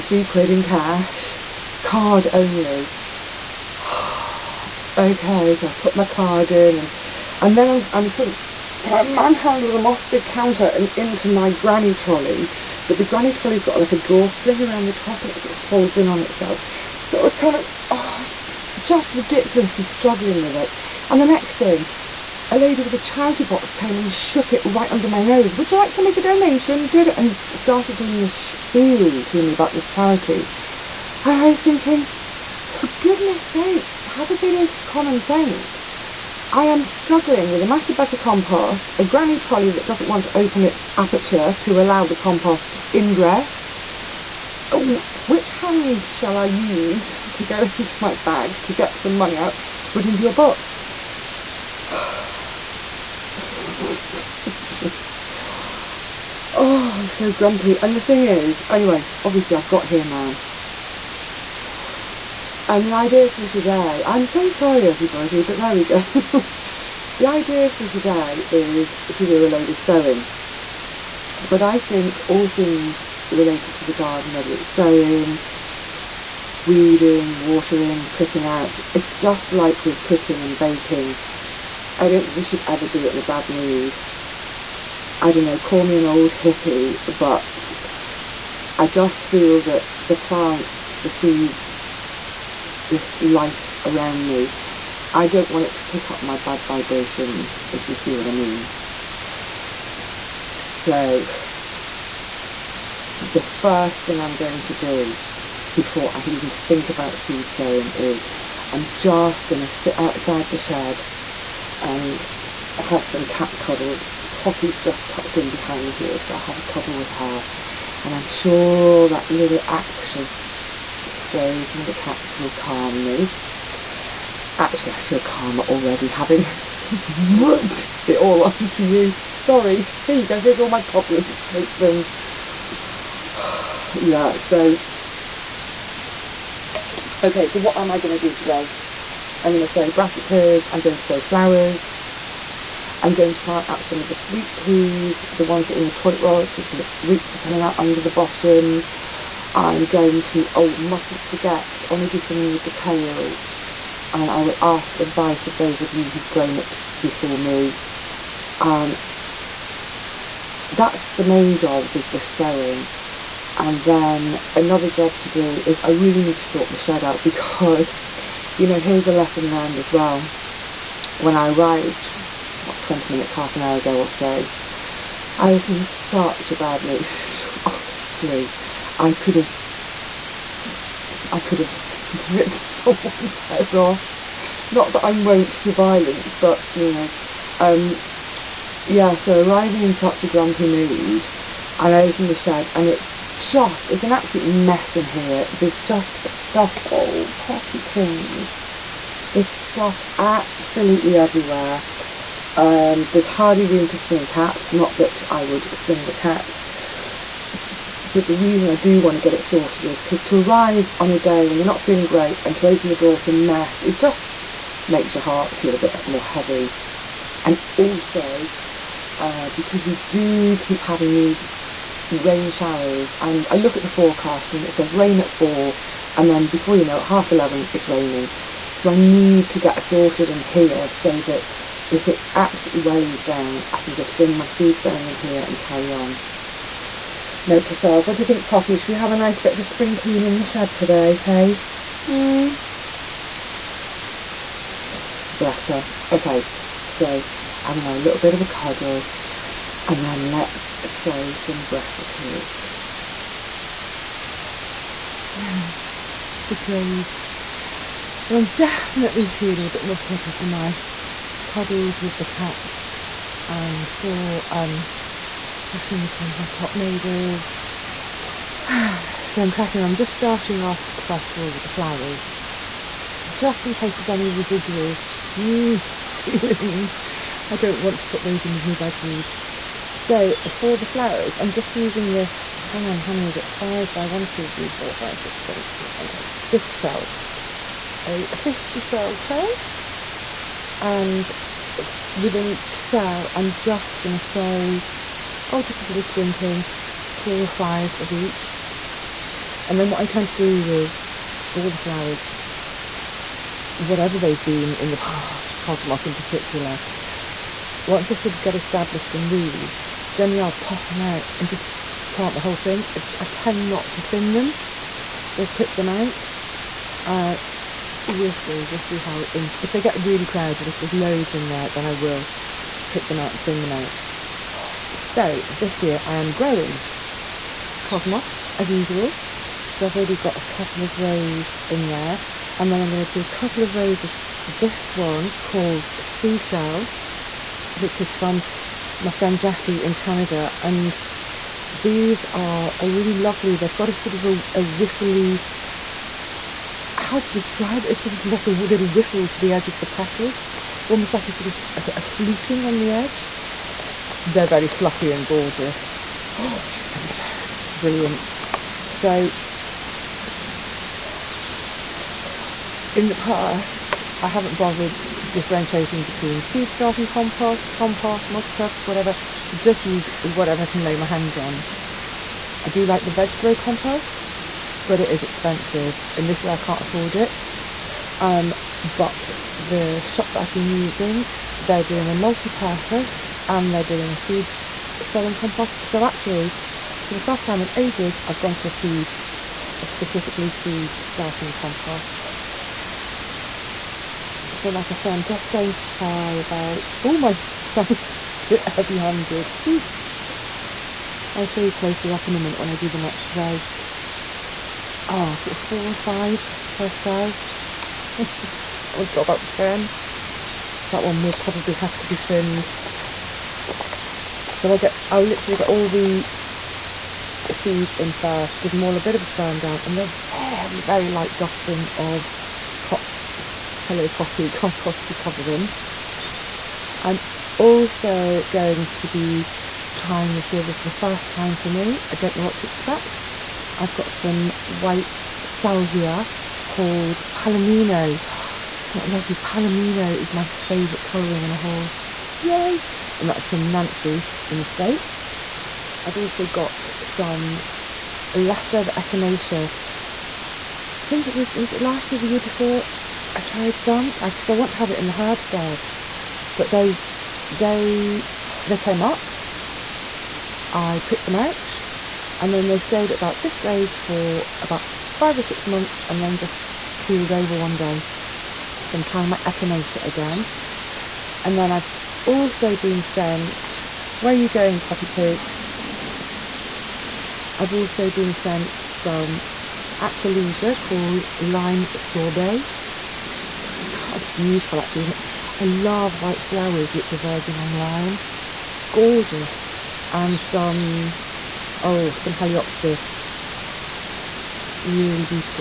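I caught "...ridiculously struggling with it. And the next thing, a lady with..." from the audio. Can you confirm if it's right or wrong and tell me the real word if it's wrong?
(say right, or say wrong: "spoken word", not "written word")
right.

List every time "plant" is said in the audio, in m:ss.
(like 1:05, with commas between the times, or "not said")
1:30, 2:23, 5:12.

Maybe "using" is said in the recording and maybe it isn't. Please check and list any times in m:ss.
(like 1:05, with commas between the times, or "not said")
4:41, 6:20.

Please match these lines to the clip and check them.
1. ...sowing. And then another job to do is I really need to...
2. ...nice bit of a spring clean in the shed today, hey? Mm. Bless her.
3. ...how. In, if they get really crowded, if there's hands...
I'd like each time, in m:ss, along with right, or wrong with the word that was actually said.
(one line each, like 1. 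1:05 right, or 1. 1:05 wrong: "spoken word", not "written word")
1. 2:42 right
2. 3:59 right
3. 5:18 wrong: "loads", not "hands".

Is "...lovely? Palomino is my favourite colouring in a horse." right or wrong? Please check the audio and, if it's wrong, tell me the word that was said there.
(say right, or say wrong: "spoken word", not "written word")
right.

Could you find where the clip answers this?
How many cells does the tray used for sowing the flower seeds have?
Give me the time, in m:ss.
4:46.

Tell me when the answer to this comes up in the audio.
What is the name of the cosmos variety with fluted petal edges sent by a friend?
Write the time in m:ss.
5:35.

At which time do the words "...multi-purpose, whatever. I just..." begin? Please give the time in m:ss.
6:08.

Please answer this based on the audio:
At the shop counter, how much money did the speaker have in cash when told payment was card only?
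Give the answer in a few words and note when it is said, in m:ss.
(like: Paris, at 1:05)
3 pounds, at 0:00.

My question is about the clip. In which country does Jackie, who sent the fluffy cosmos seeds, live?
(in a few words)
Canada.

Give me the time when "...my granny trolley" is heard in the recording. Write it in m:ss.
0:11.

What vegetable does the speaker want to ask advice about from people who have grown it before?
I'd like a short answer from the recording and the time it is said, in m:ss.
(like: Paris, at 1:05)
Kale, at 2:32.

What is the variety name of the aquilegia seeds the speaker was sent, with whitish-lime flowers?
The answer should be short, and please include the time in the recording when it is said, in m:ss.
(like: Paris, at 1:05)
Lime Sorbet, at 8:01.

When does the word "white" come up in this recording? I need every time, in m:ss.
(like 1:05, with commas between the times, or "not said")
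7:14, 8:06.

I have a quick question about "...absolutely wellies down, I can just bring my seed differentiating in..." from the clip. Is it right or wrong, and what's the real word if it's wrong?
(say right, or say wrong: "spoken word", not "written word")
wrong: "sowing", not "differentiating".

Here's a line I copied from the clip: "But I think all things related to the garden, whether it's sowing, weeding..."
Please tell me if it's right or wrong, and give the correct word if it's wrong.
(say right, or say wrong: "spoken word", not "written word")
right.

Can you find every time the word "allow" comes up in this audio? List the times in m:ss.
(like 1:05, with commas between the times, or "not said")
0:41.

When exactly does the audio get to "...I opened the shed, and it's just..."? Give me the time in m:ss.
3:11.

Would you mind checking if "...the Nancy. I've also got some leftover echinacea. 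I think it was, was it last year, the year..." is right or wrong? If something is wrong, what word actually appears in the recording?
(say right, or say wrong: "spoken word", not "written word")
wrong: "States", not "Nancy".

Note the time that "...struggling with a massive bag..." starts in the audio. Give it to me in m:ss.
0:36.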